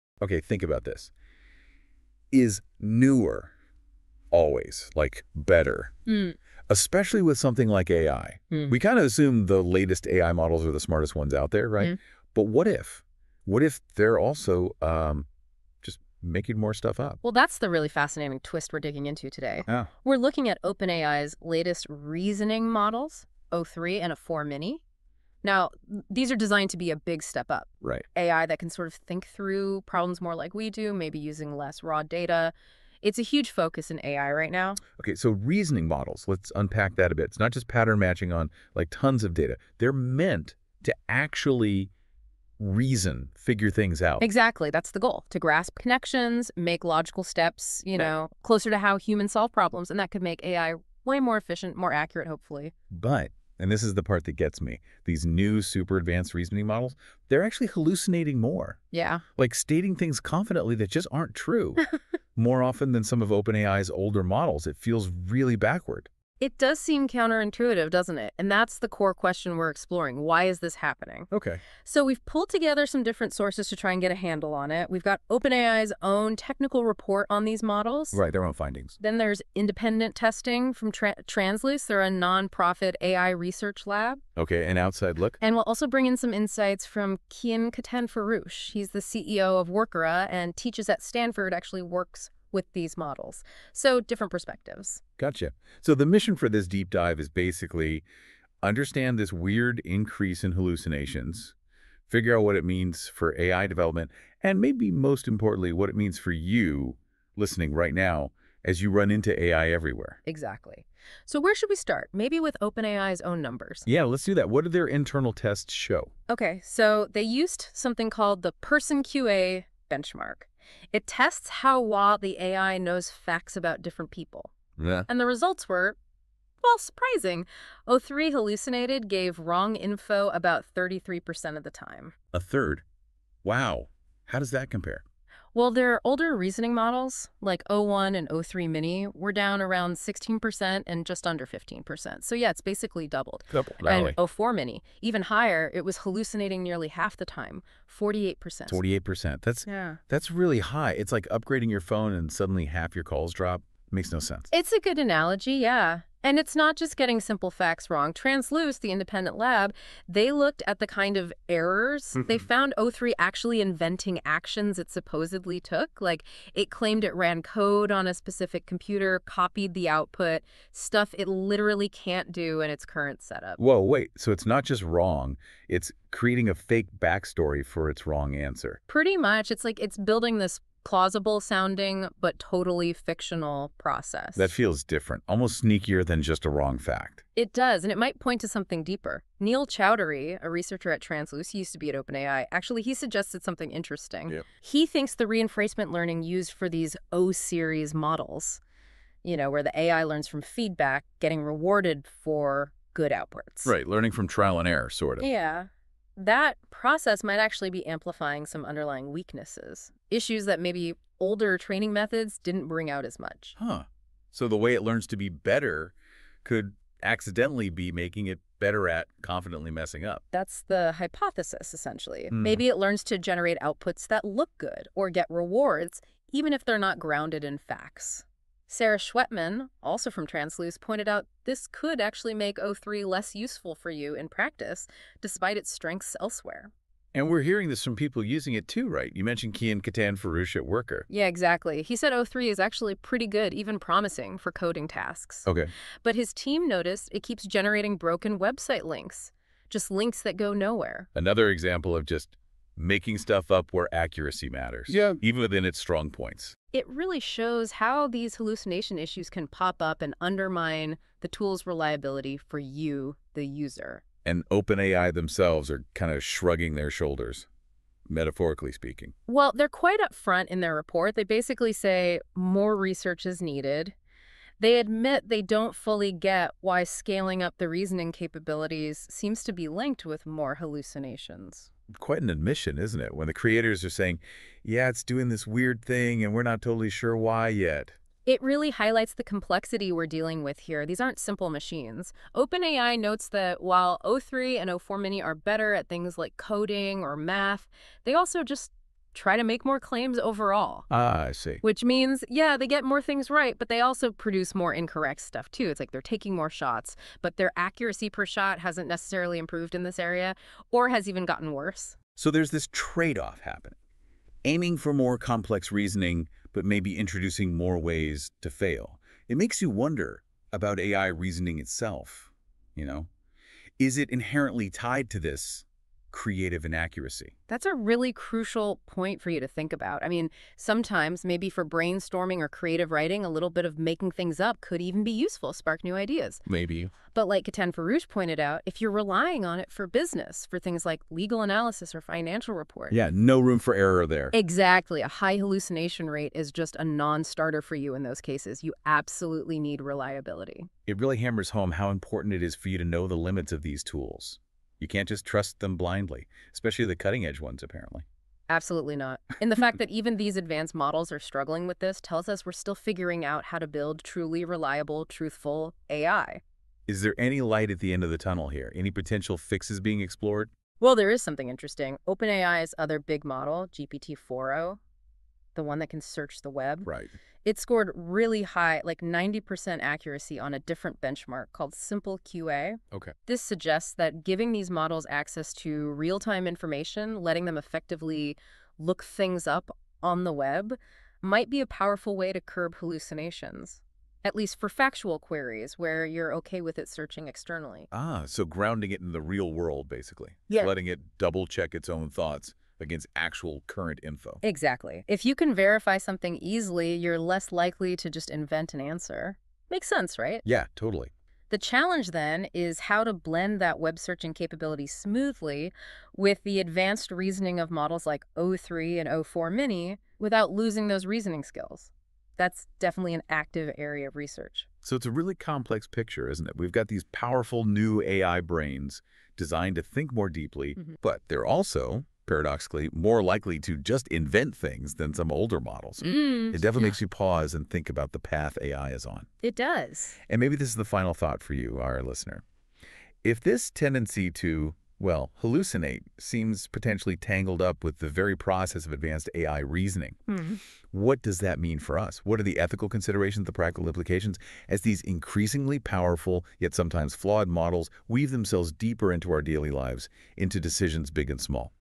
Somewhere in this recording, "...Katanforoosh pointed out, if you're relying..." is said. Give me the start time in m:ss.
5:37.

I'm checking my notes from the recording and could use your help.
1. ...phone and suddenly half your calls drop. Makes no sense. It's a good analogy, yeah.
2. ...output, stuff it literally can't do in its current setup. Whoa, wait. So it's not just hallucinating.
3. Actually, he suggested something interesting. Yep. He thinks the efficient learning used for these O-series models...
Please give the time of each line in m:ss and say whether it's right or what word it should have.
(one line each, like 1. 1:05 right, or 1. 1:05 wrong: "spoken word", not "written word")
1. 2:31 right
2. 2:49 wrong: "wrong", not "hallucinating"
3. 3:12 wrong: "reinforcement", not "efficient".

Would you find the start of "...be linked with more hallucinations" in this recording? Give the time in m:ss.
4:39.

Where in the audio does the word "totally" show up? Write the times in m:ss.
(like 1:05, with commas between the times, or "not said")
3:02, 4:46, 6:50.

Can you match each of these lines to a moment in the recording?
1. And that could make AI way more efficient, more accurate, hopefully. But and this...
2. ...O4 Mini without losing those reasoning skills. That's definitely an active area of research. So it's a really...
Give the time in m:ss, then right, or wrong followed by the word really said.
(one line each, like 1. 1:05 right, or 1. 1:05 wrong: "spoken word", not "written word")
1. 0:49 right
2. 6:59 right.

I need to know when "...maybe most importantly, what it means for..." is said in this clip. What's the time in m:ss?
1:44.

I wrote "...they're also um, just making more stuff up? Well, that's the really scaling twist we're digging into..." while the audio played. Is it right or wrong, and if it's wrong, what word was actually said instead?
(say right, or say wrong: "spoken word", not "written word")
wrong: "fascinating", not "scaling".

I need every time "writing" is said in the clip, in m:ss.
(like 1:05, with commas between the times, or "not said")
5:32.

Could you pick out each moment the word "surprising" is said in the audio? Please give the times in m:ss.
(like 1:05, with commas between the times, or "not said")
2:06.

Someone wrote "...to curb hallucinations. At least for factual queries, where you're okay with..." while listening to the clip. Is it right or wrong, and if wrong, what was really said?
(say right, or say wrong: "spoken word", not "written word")
right.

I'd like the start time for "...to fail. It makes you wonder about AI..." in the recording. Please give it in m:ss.
5:18.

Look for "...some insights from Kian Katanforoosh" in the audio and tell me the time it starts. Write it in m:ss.
1:26.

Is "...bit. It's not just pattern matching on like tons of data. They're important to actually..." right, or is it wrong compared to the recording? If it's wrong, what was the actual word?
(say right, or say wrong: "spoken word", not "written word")
wrong: "meant", not "important".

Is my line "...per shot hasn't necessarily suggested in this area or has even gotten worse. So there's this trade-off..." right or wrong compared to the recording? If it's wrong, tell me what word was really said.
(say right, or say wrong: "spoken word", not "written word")
wrong: "improved", not "suggested".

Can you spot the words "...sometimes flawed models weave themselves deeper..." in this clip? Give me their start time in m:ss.
7:36.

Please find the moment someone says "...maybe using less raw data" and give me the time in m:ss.
0:30.